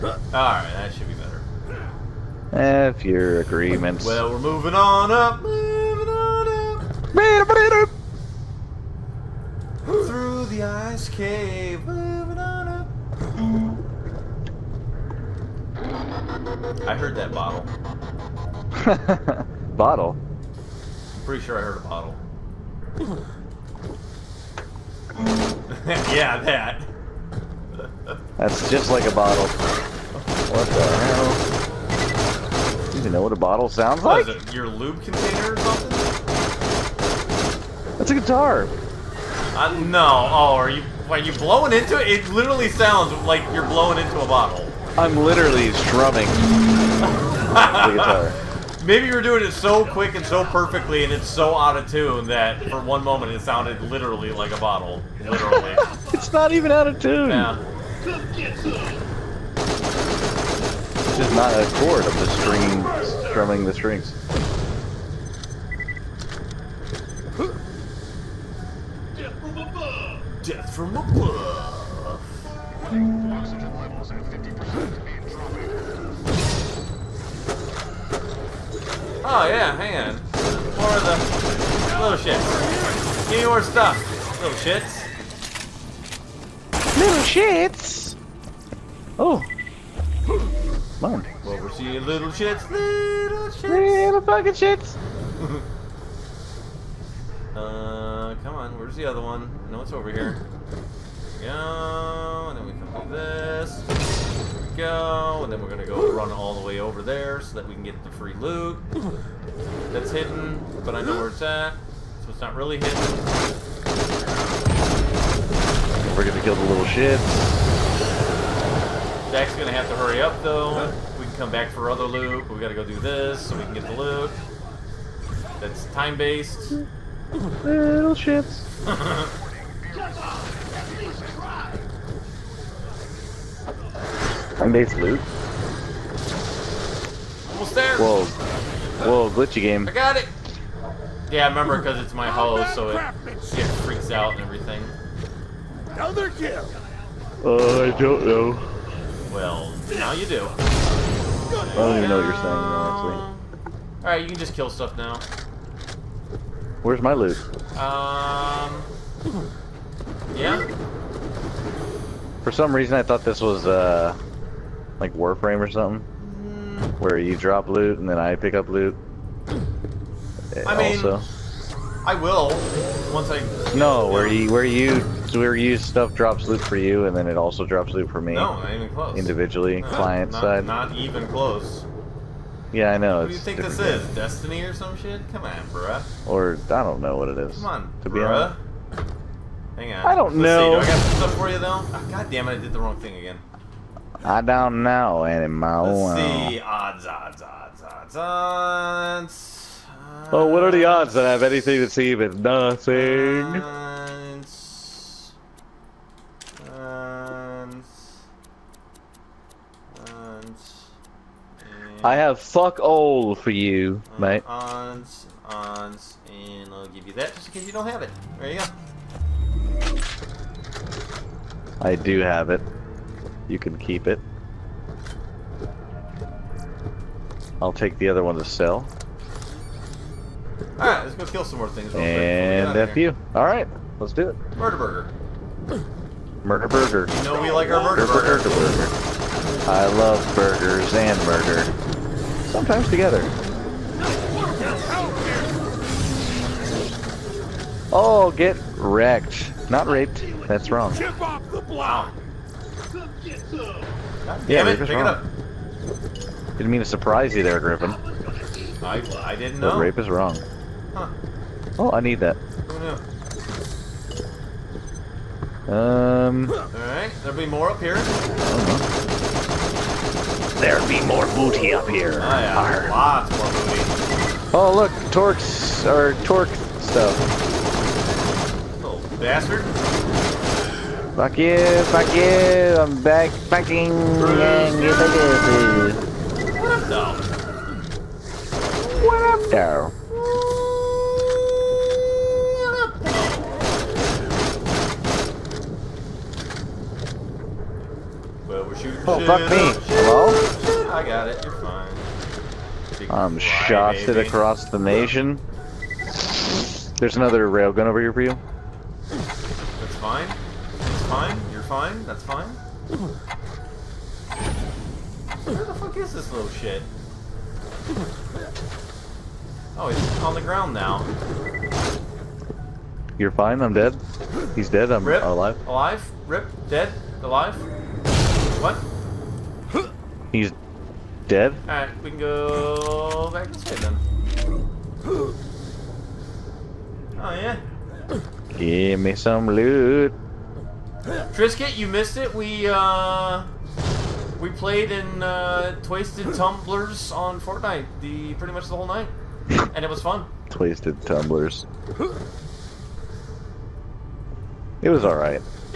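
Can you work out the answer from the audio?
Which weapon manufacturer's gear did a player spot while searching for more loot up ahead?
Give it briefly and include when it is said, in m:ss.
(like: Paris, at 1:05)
Torgue, at 4:36.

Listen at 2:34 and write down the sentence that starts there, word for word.
Alright, you can just kill stuff now.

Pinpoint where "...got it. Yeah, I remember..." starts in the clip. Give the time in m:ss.
2:19.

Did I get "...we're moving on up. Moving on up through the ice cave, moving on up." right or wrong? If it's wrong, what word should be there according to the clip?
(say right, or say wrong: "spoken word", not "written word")
right.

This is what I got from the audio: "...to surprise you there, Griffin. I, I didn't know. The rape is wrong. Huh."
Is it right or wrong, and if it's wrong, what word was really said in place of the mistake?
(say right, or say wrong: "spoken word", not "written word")
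right.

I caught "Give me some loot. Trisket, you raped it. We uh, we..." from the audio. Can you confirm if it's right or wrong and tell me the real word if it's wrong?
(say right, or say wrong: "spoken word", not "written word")
wrong: "missed", not "raped".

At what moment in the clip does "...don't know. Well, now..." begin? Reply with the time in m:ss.
2:27.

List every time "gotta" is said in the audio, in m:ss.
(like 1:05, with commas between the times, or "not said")
2:02.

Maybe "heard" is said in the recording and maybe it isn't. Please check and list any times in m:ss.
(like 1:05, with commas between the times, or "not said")
0:16, 0:21.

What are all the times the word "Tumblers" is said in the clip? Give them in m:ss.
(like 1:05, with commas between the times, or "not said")
5:46, 5:51.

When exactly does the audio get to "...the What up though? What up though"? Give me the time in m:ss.
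4:44.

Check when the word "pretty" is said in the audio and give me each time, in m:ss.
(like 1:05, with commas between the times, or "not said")
0:21, 5:48.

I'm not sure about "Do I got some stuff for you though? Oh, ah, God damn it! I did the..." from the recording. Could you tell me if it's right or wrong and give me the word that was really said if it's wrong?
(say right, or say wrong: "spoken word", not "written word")
right.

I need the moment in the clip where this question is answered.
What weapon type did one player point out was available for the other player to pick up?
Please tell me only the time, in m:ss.
5:07.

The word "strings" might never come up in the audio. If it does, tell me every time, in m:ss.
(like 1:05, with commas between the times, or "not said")
1:03.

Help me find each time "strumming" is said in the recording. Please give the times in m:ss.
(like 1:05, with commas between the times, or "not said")
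0:45, 1:03.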